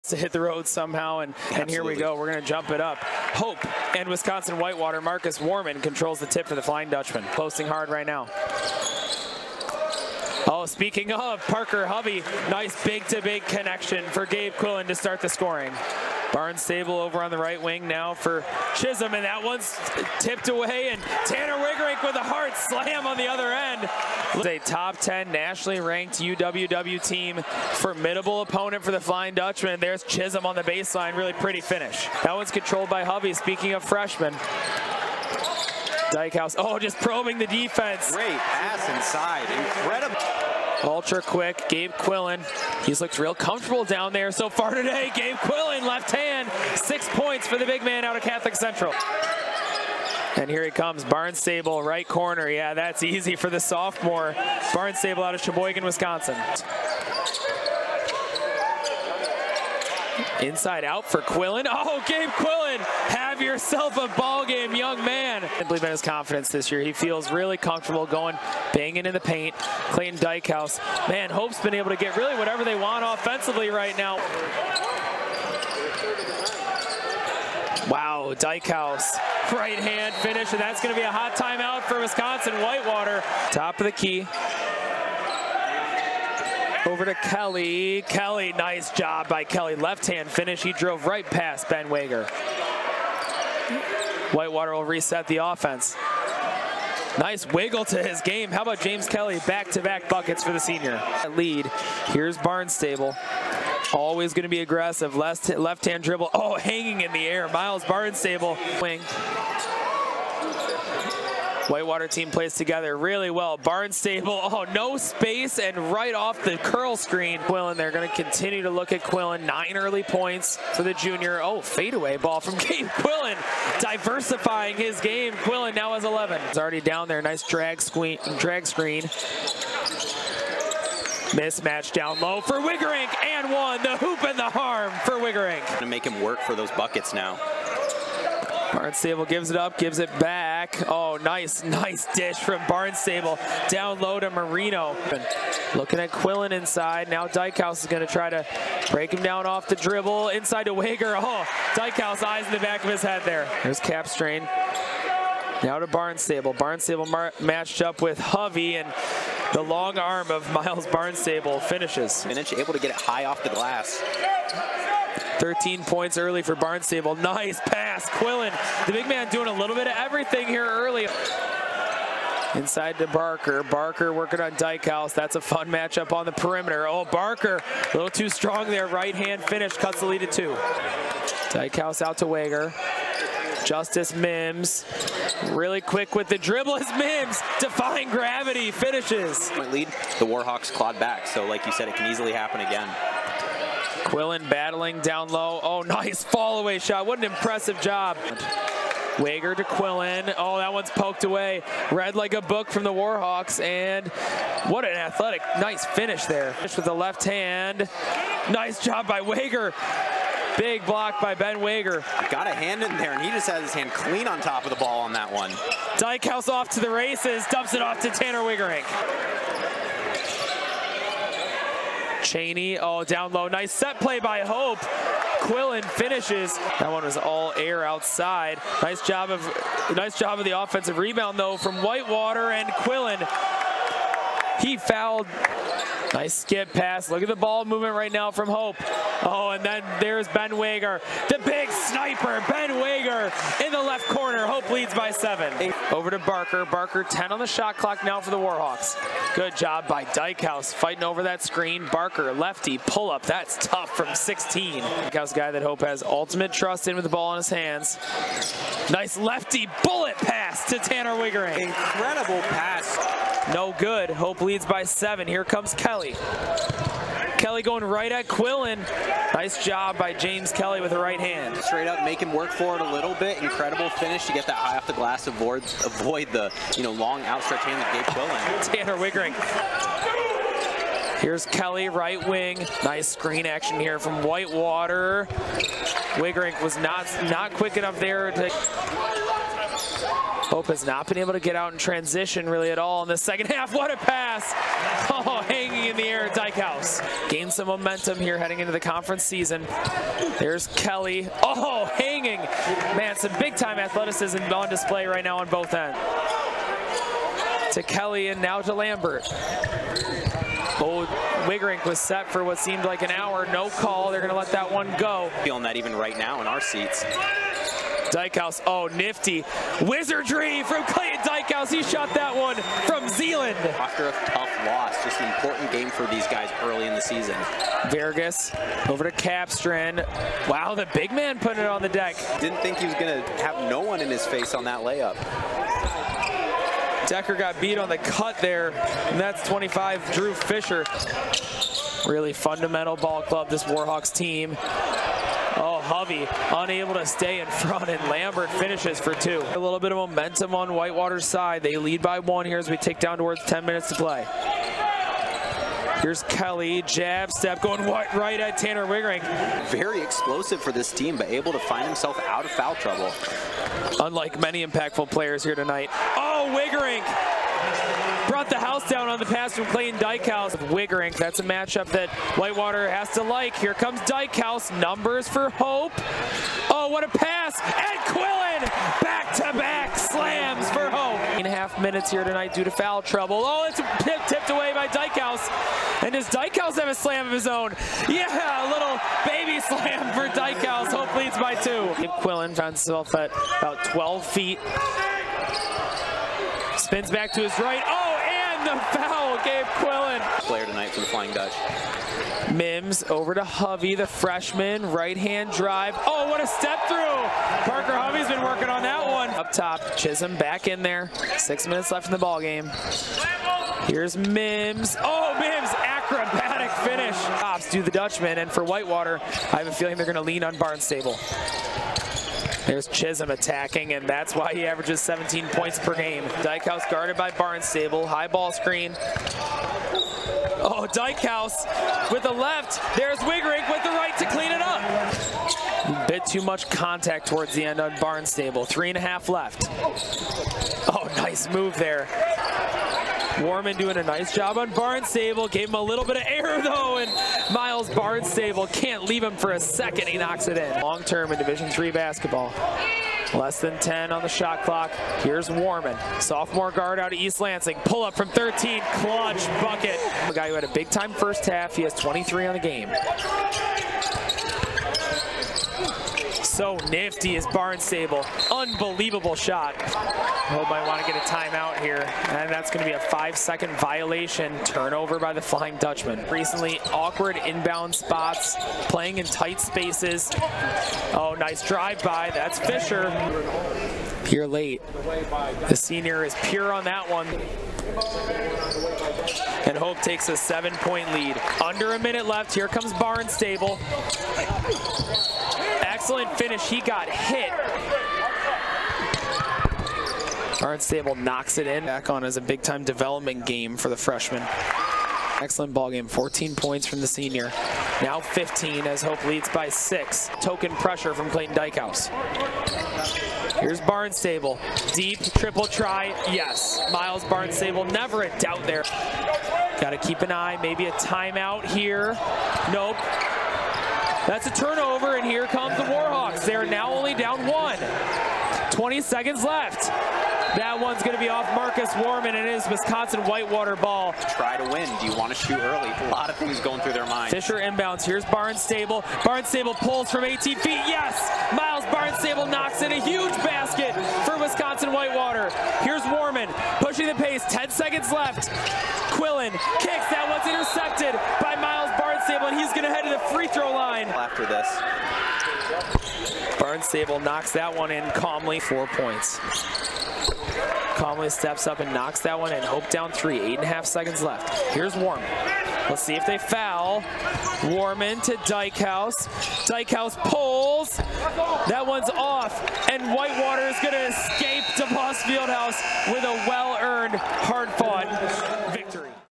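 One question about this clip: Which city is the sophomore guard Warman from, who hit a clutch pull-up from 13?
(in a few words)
East Lansing.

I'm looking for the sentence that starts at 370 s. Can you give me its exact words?
Wiggerink, that's a matchup that Whitewater has to like.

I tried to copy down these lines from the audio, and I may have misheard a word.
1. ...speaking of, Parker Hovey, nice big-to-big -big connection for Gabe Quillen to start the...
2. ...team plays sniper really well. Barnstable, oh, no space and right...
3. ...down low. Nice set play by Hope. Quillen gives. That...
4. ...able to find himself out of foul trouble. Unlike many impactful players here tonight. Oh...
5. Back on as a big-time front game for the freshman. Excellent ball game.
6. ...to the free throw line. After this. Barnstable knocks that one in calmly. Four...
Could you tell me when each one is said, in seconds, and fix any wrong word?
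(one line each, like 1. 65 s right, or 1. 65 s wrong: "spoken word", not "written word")
1. 10 s right
2. 112 s wrong: "together", not "sniper"
3. 223 s wrong: "finishes", not "gives"
4. 361 s right
5. 501 s wrong: "development", not "front"
6. 553 s right.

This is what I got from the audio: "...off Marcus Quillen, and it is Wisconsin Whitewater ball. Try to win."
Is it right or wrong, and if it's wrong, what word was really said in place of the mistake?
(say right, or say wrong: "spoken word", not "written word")
wrong: "Warman", not "Quillen".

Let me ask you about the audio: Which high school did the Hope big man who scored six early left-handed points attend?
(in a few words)
Catholic Central.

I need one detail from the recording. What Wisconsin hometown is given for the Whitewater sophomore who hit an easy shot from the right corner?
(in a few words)
Sheboygan, Wisconsin.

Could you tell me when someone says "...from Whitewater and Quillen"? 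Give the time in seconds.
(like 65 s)
231 s.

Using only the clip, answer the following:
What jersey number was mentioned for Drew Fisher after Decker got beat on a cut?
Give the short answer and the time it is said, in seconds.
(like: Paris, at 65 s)
25, at 339 s.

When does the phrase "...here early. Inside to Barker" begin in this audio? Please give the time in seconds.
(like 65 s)
170 s.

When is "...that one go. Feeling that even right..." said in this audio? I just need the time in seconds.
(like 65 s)
314 s.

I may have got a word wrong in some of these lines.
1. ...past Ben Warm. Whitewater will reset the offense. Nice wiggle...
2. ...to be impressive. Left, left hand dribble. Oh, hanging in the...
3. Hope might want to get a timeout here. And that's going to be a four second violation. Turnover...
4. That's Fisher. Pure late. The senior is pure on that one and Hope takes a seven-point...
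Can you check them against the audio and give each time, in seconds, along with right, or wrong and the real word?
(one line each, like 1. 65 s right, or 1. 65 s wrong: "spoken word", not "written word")
1. 91 s wrong: "Wager", not "Warm"
2. 104 s wrong: "aggressive", not "impressive"
3. 469 s wrong: "five", not "four"
4. 482 s right.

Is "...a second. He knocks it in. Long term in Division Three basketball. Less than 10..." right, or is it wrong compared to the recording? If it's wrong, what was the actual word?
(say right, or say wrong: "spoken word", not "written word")
right.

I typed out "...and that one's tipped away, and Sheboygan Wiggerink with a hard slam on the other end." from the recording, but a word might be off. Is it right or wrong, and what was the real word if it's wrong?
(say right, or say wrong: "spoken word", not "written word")
wrong: "Tanner", not "Sheboygan".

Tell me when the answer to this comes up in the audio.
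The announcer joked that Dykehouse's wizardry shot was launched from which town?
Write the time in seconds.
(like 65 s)
323 s.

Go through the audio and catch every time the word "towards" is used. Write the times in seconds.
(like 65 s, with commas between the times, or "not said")
353 s, 437 s.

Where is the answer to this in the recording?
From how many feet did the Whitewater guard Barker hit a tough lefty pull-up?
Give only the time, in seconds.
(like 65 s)
254 s.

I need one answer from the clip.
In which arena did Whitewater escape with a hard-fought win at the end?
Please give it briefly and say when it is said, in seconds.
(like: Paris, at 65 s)
DeVos Fieldhouse, at 574 s.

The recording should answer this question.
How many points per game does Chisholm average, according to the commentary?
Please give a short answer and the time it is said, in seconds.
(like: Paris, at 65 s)
17, at 425 s.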